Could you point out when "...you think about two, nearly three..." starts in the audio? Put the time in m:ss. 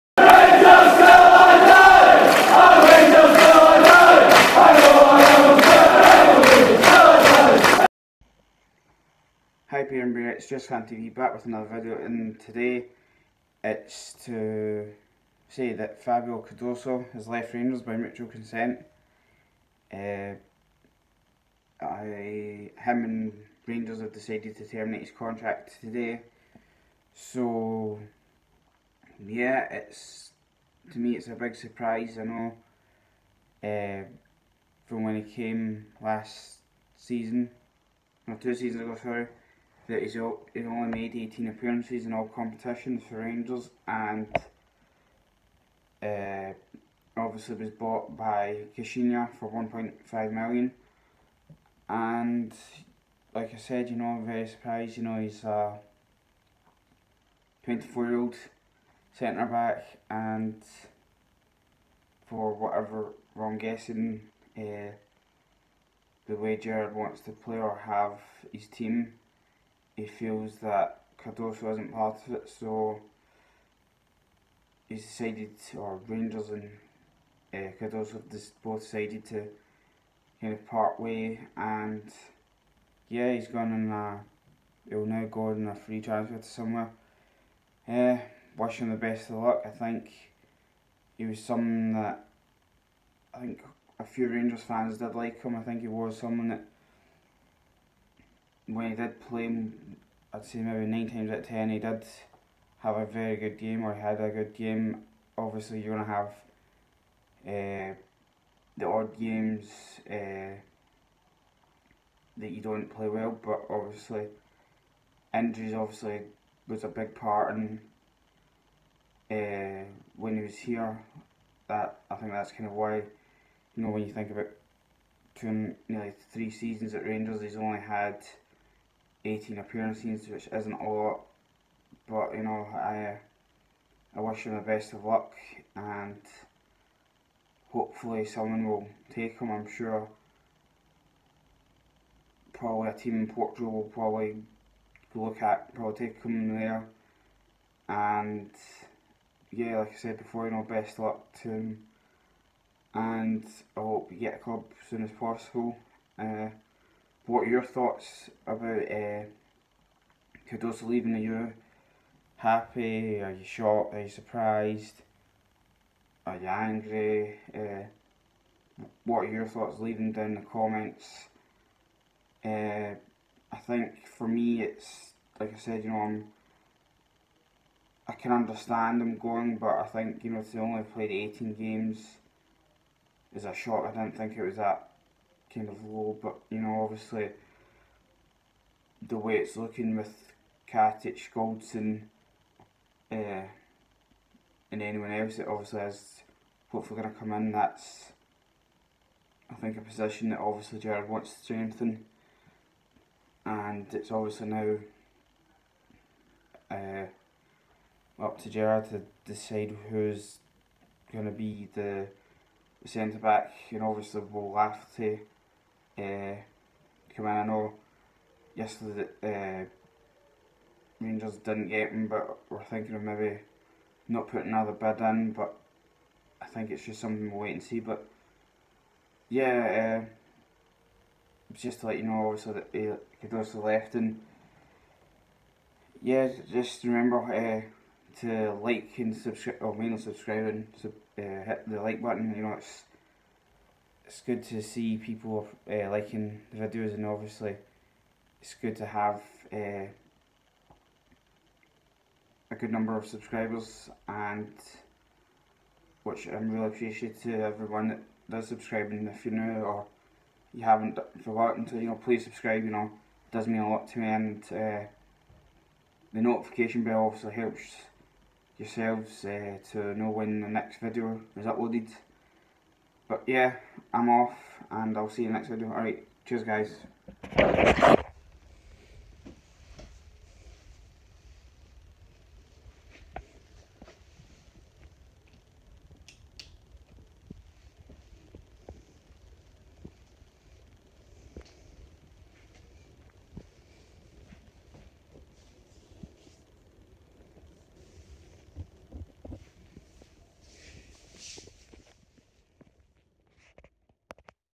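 2:04.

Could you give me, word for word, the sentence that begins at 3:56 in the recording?
Yeah, just remember uh, to like and subscribe, oh, or mainly subscribe and sub, uh, hit the like button.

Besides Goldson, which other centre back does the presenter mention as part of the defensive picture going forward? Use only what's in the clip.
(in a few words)
Katic.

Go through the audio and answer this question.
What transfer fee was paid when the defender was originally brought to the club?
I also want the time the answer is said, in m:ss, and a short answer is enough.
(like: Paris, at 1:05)
1.5 million, at 0:49.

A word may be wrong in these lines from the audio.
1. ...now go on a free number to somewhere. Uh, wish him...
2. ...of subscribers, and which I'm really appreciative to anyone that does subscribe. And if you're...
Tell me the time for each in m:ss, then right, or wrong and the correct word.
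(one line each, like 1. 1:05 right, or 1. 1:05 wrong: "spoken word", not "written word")
1. 1:25 wrong: "transfer", not "number"
2. 4:12 wrong: "everyone", not "anyone".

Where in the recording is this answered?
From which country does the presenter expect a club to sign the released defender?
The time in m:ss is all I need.
2:23.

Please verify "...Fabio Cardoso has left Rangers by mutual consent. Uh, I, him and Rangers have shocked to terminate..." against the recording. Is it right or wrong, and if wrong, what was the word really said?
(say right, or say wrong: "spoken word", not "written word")
wrong: "decided", not "shocked".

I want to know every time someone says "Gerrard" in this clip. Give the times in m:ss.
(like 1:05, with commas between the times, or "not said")
1:06, 3:20, 3:28.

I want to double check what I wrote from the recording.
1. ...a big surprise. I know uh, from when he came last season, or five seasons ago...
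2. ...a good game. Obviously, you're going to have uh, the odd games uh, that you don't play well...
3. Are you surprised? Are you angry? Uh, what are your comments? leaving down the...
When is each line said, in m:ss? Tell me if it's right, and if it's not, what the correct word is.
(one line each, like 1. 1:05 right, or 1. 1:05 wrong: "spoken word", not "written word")
1. 0:31 wrong: "two", not "five"
2. 1:44 right
3. 2:43 wrong: "thoughts", not "comments".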